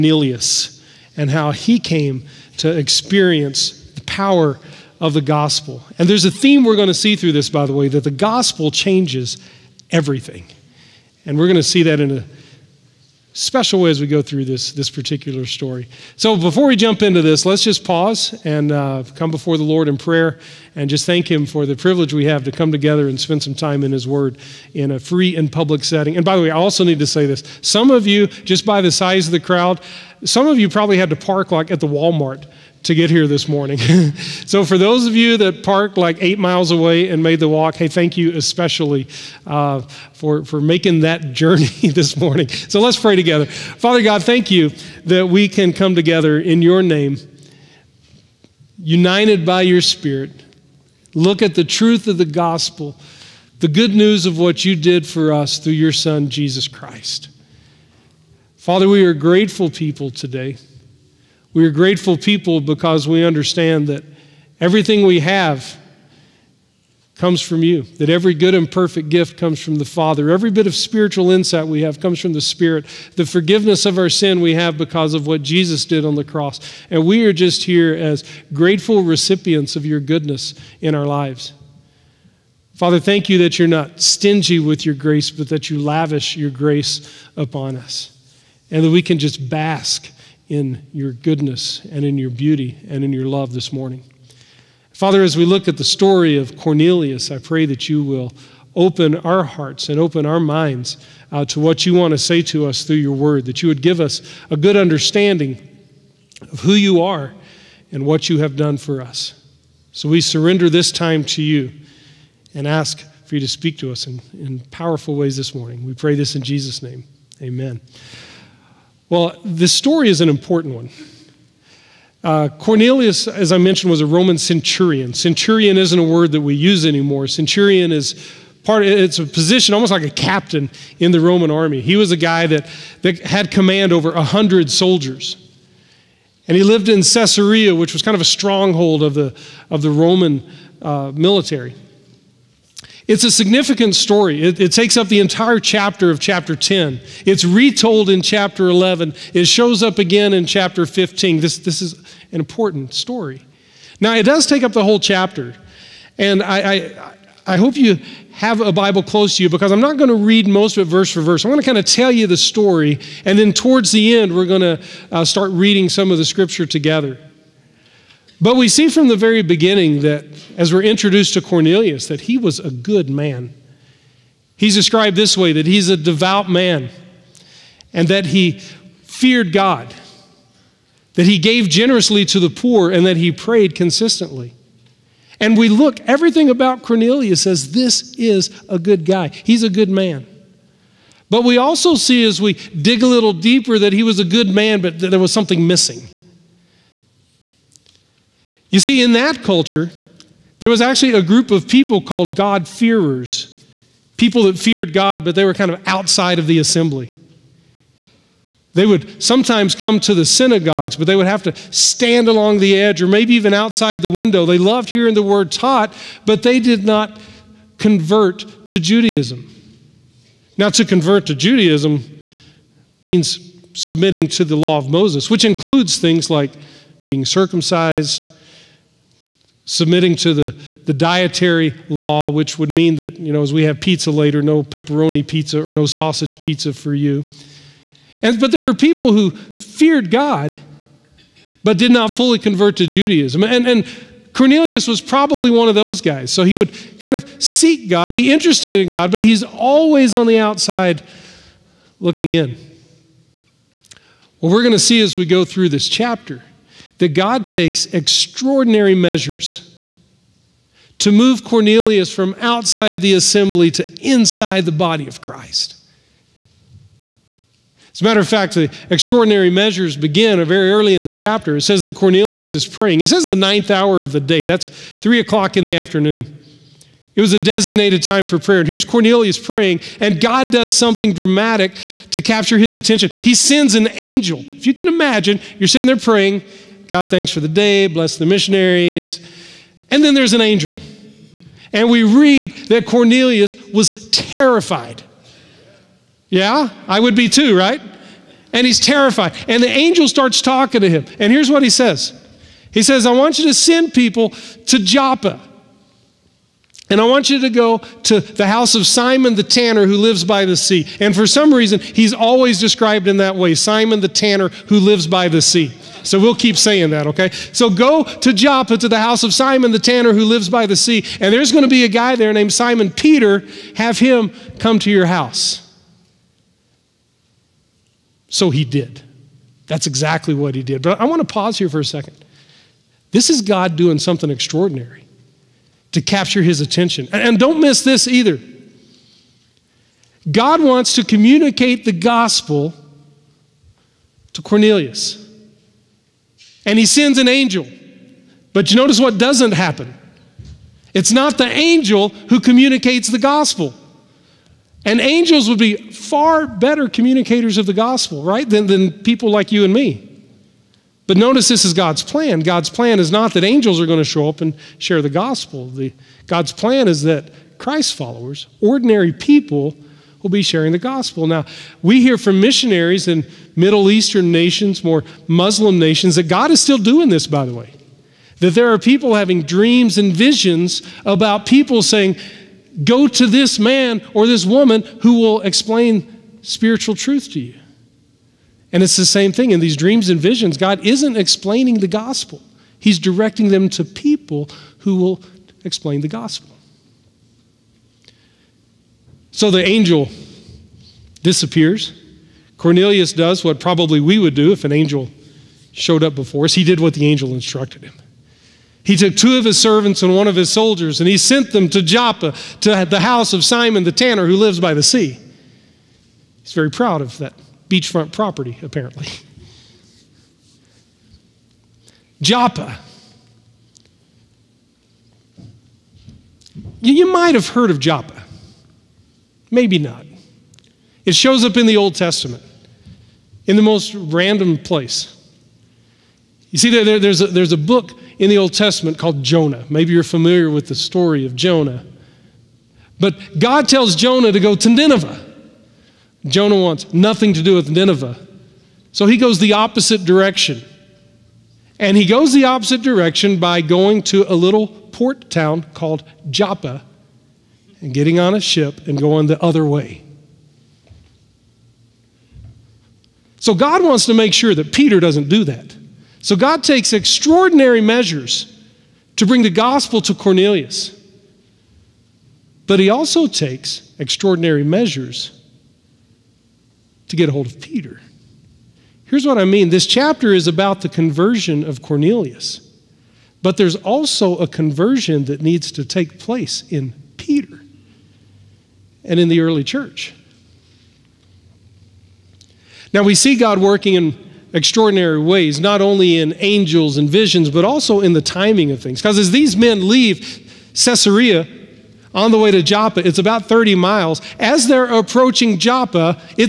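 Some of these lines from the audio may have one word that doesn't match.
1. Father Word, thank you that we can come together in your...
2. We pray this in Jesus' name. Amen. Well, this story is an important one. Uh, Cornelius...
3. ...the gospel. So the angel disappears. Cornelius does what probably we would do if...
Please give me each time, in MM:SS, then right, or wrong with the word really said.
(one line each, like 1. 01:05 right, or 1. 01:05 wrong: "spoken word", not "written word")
1. 00:43 wrong: "God", not "Word"
2. 01:55 right
3. 06:36 right.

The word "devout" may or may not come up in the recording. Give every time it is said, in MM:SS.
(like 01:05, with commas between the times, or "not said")
02:55.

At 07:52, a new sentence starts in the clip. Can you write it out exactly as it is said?
But he also takes extraordinary measures to get a hold of Peter.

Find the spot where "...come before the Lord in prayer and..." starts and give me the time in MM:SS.
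00:19.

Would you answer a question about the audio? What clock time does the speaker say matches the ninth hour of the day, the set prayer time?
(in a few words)
3 o'clock in the afternoon.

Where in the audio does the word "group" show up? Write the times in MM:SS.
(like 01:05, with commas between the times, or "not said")
03:21.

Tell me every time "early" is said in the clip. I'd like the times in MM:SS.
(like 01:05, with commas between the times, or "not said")
04:30, 08:09.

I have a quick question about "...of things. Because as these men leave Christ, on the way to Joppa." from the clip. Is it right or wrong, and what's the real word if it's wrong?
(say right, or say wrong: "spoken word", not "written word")
wrong: "Caesarea", not "Christ".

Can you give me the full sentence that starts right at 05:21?
And there's going to be a guy there named Simon Peter.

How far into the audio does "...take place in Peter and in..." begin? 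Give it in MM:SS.
08:05.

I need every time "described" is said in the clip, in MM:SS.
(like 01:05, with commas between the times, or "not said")
02:54, 05:12.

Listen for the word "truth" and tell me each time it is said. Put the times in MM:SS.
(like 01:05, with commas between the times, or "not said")
00:51, 06:26.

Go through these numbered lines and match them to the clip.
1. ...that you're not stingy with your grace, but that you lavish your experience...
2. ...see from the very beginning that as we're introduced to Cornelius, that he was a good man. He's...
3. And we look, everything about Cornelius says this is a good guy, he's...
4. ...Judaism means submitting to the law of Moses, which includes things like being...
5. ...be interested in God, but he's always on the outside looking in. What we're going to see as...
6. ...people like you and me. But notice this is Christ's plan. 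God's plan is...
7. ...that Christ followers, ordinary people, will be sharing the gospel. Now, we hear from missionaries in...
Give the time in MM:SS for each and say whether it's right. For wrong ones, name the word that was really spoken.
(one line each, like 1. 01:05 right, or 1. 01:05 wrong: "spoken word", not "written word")
1. 01:23 wrong: "grace", not "experience"
2. 02:48 right
3. 03:05 right
4. 03:41 right
5. 04:08 right
6. 05:59 wrong: "God", not "Christ"
7. 06:07 right.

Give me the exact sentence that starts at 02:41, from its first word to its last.
I'm going to kind of tell you the story.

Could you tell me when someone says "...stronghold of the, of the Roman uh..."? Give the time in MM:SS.
02:18.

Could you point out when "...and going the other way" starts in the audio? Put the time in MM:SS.
07:38.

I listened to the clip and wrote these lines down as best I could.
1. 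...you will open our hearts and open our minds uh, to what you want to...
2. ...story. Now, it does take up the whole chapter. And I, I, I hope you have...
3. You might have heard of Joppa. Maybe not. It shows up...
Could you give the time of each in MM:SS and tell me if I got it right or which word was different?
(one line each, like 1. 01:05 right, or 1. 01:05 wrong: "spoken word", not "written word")
1. 01:37 right
2. 02:32 right
3. 07:06 right.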